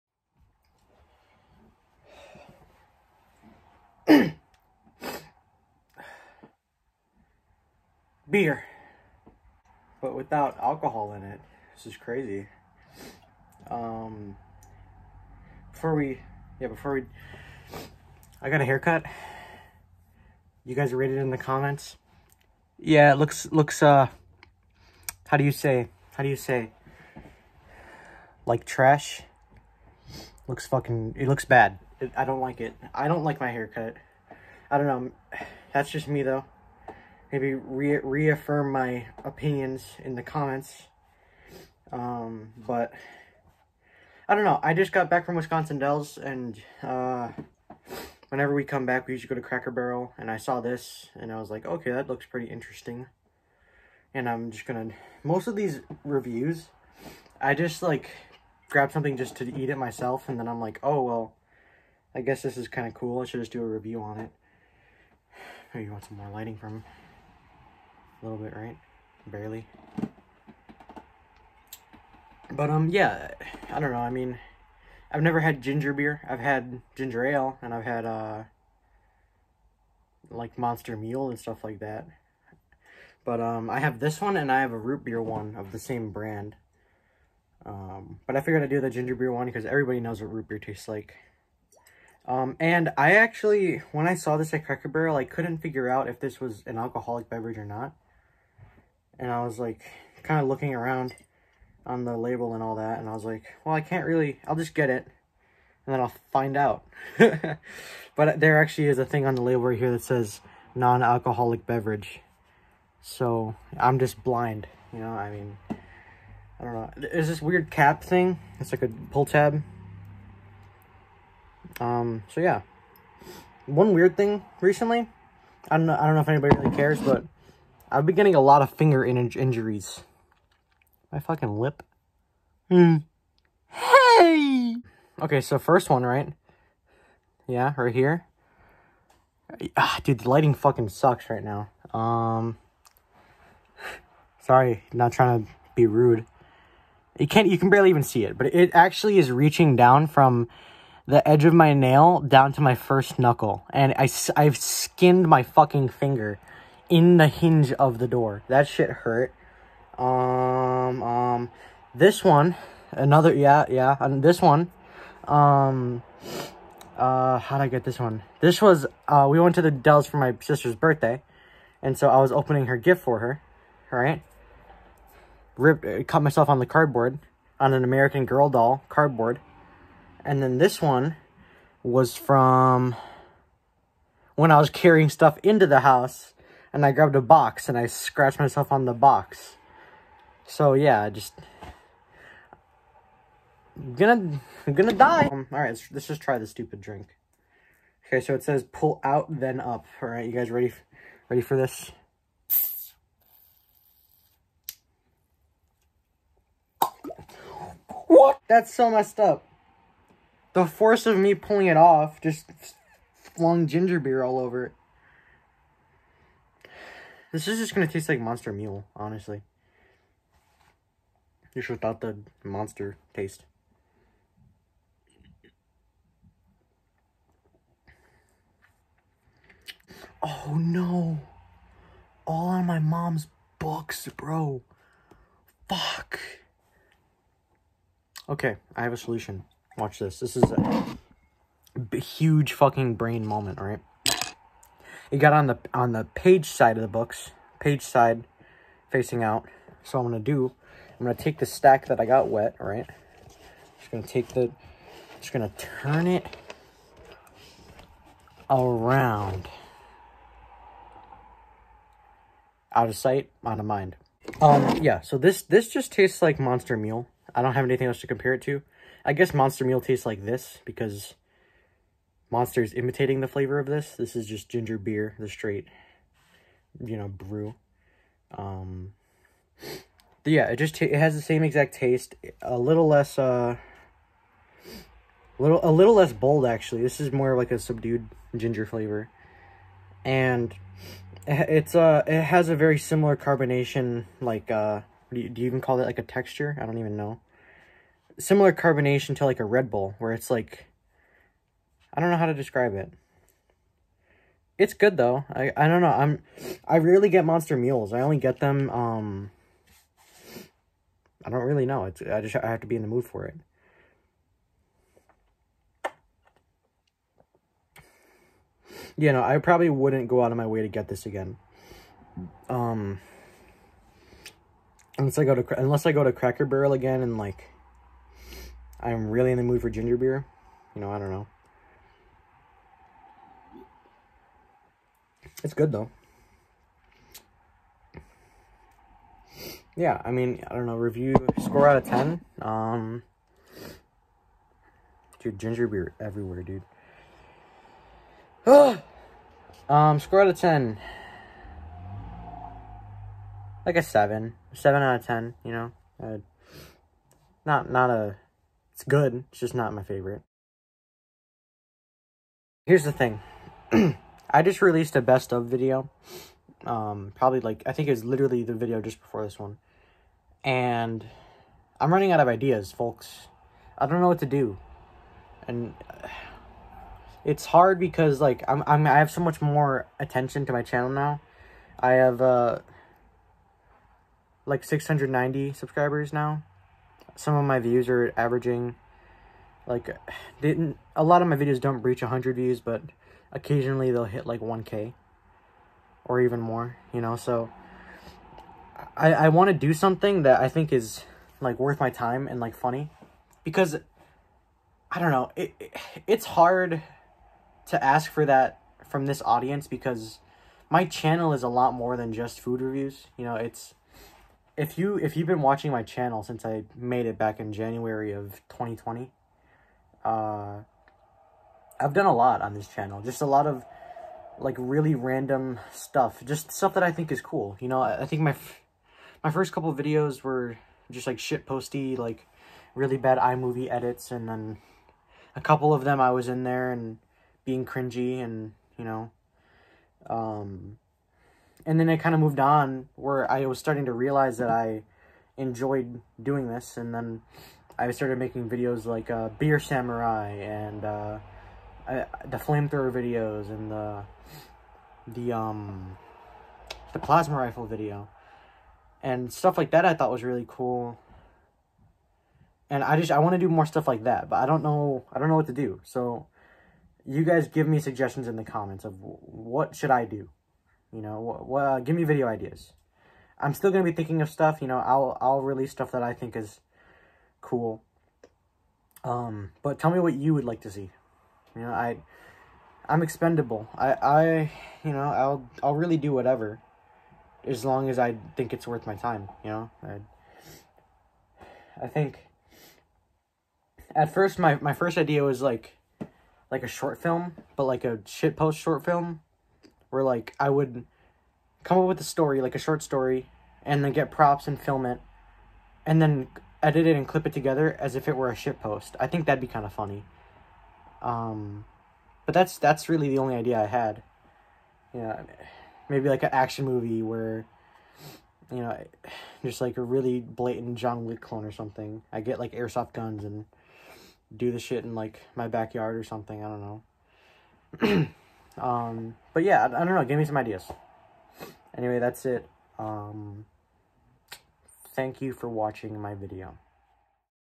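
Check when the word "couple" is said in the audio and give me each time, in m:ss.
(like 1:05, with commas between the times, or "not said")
7:09, 7:15.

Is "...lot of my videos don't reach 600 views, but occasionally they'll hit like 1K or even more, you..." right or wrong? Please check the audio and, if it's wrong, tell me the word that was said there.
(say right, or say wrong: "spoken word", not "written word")
wrong: "100", not "600".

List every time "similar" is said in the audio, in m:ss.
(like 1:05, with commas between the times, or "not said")
4:52, 4:58.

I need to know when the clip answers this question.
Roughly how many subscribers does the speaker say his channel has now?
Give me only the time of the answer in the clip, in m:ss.
6:24.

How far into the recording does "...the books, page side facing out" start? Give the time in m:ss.
4:06.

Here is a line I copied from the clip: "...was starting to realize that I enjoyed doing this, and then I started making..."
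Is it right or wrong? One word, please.
right.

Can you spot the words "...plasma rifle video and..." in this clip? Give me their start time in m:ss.
7:36.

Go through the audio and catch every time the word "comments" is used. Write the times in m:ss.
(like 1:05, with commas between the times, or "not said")
0:21, 0:40, 7:48.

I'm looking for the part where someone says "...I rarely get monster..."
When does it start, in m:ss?
5:06.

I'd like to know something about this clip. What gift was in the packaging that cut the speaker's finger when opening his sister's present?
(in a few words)
American Girl doll.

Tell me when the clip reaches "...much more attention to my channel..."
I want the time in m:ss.
6:19.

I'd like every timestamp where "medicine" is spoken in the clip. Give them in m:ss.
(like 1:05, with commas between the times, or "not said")
not said.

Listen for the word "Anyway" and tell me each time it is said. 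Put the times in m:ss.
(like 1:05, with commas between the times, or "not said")
8:51.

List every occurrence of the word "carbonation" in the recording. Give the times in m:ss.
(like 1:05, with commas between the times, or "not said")
4:53, 4:58.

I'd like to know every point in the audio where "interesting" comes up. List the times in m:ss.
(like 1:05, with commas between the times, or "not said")
0:52.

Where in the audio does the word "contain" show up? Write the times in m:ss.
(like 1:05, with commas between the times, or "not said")
not said.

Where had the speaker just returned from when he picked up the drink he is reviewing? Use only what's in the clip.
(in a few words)
Wisconsin Dells.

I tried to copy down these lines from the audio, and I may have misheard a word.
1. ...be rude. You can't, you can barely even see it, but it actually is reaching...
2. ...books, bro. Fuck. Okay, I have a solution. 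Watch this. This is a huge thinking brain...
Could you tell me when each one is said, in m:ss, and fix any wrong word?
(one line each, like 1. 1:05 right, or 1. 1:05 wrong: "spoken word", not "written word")
1. 2:25 right
2. 3:53 wrong: "fucking", not "thinking".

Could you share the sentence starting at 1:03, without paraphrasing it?
I should just do a review on it.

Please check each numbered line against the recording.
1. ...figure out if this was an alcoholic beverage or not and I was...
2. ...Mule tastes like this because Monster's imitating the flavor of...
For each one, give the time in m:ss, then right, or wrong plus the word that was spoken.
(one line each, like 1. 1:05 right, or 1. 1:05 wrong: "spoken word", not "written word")
1. 1:35 right
2. 4:29 right.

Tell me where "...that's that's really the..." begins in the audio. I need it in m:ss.
8:32.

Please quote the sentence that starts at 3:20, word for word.
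All right, you guys ready ready for this?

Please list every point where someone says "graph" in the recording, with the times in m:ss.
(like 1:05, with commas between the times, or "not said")
not said.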